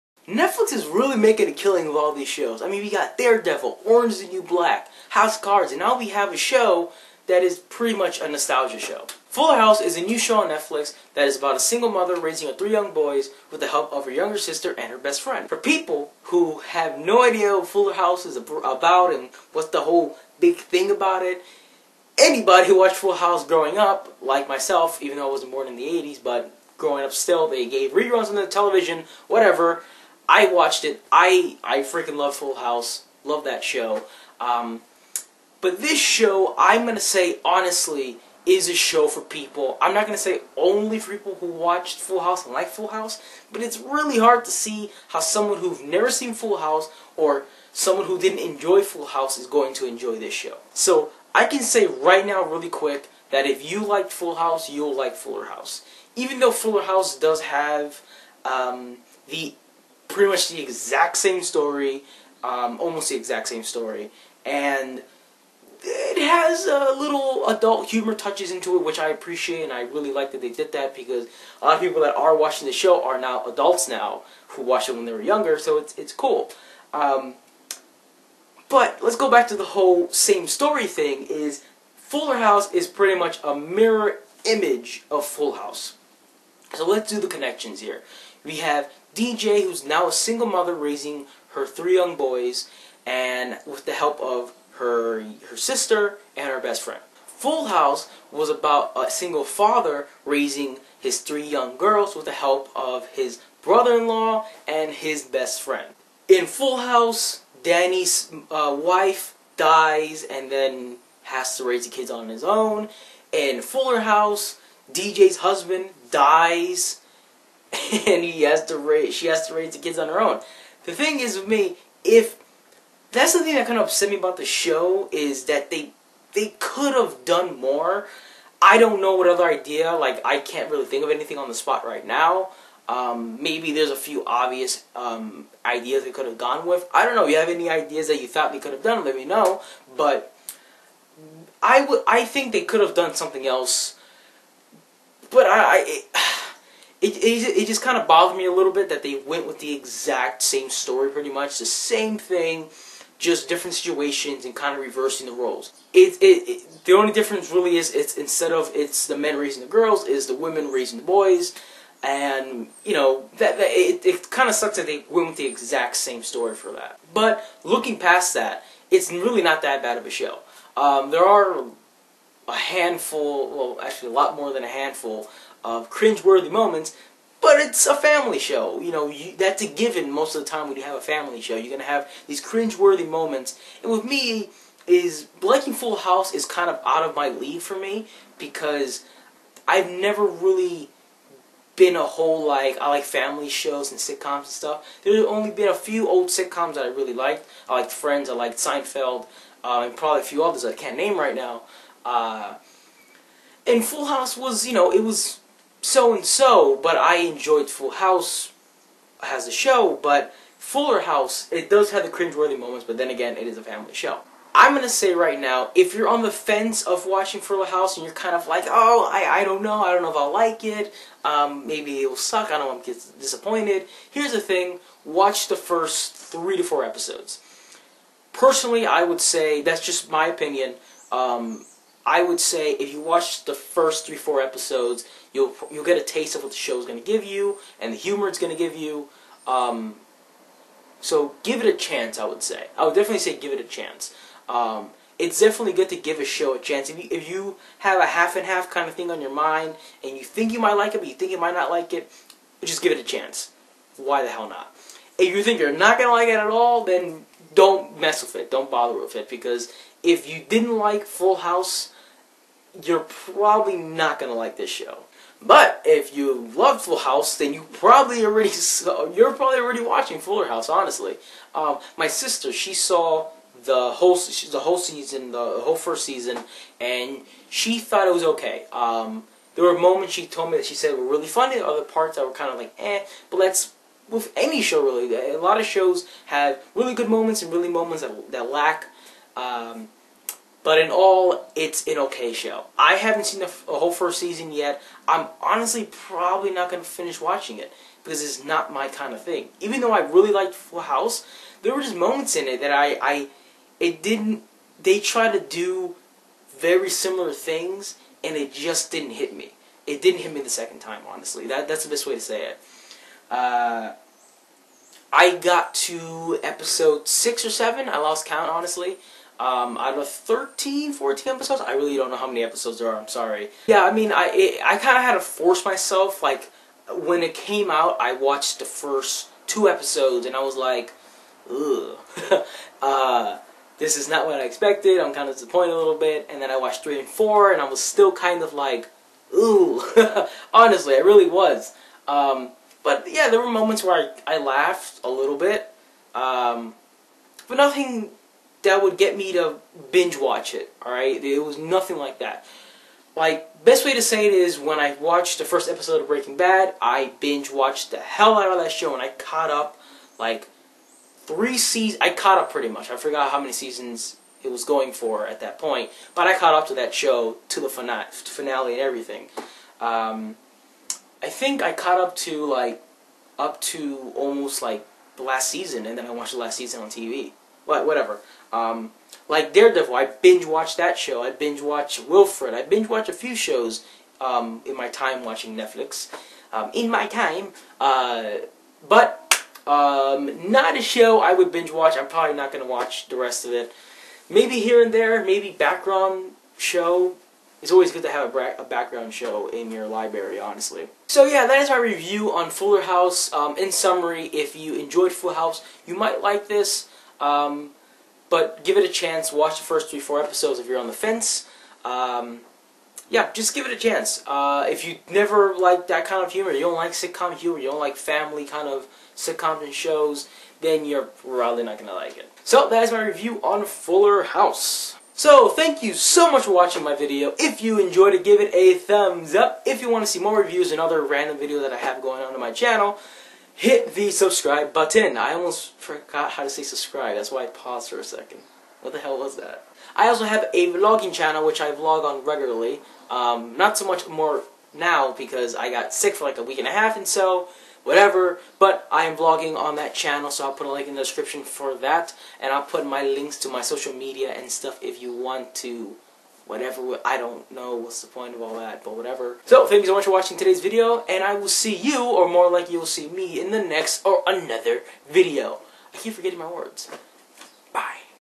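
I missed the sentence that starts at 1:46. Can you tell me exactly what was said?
In Full House, Danny's uh, wife dies and then has to raise the kids on his own.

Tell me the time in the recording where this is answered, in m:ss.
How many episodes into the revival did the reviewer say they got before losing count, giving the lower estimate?
5:17.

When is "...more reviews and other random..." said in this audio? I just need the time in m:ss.
7:10.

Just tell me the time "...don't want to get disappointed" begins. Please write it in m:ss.
3:42.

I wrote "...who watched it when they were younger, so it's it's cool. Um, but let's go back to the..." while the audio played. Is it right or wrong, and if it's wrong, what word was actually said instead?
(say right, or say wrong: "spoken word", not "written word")
right.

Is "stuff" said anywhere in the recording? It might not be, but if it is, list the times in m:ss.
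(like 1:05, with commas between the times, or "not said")
3:14, 7:34.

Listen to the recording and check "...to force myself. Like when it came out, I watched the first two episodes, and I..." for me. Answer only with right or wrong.
right.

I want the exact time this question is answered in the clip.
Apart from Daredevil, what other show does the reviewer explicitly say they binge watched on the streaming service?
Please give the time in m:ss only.
6:22.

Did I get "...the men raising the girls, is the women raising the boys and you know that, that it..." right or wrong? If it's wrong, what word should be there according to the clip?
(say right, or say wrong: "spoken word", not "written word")
right.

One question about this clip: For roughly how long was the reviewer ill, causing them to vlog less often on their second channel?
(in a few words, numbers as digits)
A week and a half.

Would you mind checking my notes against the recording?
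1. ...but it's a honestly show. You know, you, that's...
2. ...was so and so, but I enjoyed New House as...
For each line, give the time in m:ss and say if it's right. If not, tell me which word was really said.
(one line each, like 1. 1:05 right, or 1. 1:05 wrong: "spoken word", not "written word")
1. 2:57 wrong: "family", not "honestly"
2. 3:25 wrong: "Full", not "New".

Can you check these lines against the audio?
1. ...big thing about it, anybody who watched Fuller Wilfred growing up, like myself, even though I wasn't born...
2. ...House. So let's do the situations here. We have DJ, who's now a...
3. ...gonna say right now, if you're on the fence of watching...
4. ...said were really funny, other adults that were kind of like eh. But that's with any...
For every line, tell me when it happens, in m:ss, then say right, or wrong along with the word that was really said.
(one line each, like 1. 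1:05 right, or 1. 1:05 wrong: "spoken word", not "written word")
1. 0:20 wrong: "House", not "Wilfred"
2. 1:25 wrong: "connections", not "situations"
3. 3:34 right
4. 4:40 wrong: "parts", not "adults".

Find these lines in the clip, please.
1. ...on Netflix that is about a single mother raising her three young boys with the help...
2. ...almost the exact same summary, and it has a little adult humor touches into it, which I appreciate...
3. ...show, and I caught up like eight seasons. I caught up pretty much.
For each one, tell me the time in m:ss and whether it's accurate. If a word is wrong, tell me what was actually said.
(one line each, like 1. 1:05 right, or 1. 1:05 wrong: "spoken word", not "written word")
1. 0:10 right
2. 1:02 wrong: "story", not "summary"
3. 5:58 wrong: "three", not "eight".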